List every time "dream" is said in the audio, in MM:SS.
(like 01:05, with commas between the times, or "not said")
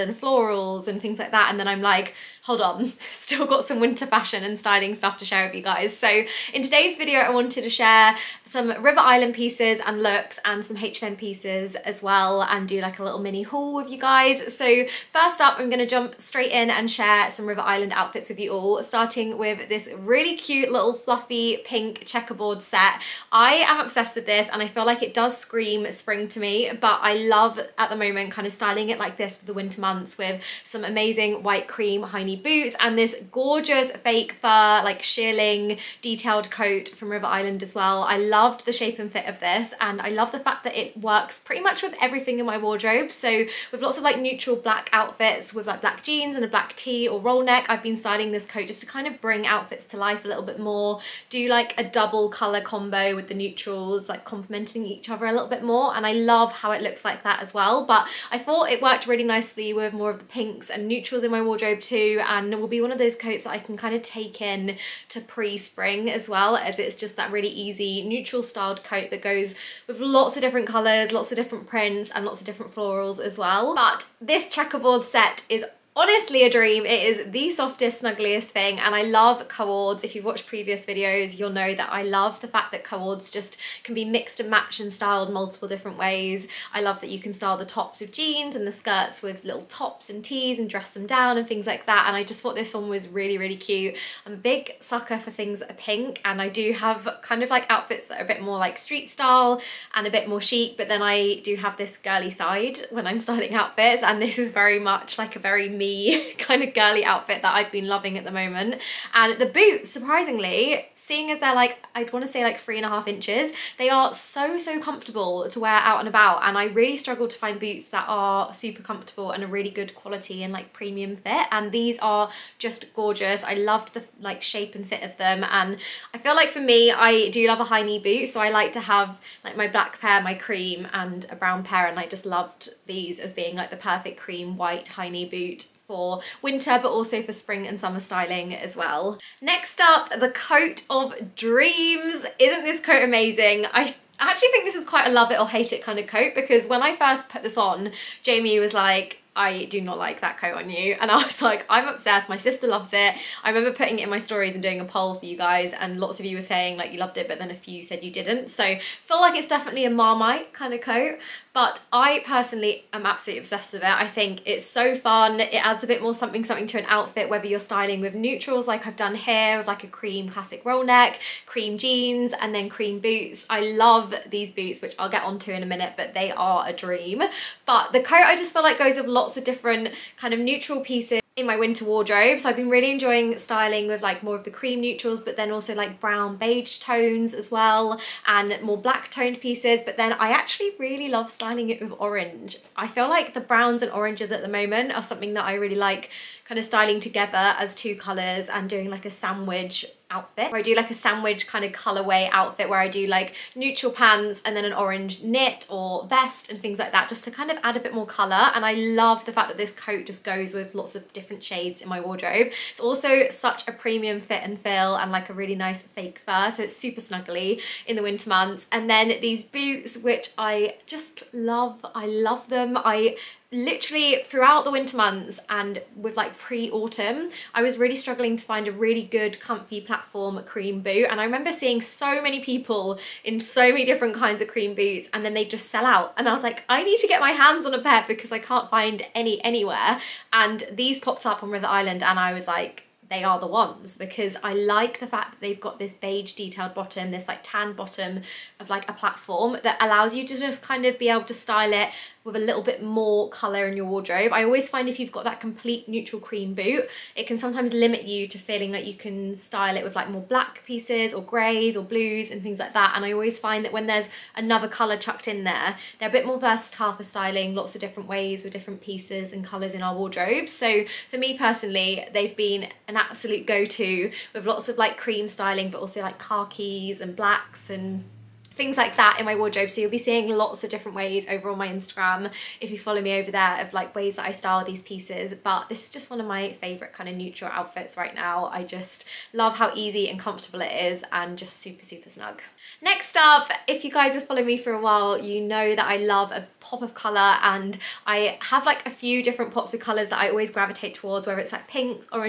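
01:16, 02:21, 02:56.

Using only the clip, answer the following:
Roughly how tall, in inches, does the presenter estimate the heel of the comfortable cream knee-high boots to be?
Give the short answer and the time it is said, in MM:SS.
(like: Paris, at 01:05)
3.5 inches, at 01:52.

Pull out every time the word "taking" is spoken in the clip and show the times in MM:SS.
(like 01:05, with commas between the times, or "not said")
not said.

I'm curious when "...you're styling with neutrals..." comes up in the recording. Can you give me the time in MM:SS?
02:47.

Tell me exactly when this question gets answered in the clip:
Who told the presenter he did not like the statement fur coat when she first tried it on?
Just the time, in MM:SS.
02:28.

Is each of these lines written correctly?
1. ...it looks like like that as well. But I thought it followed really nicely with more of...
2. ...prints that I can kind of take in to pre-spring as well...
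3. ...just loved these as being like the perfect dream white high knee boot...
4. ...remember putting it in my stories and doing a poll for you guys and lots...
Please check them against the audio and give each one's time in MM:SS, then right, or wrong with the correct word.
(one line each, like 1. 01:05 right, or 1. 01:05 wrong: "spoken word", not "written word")
1. 00:56 wrong: "worked", not "followed"
2. 01:03 wrong: "coats", not "prints"
3. 02:12 wrong: "cream", not "dream"
4. 02:33 right.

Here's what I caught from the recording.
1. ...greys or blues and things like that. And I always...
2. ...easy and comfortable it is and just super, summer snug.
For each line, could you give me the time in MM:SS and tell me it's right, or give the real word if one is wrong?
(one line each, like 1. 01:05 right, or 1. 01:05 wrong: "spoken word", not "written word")
1. 04:21 right
2. 04:49 wrong: "super", not "summer".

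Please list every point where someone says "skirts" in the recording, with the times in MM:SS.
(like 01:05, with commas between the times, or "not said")
01:28.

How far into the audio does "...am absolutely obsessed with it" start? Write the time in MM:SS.
02:42.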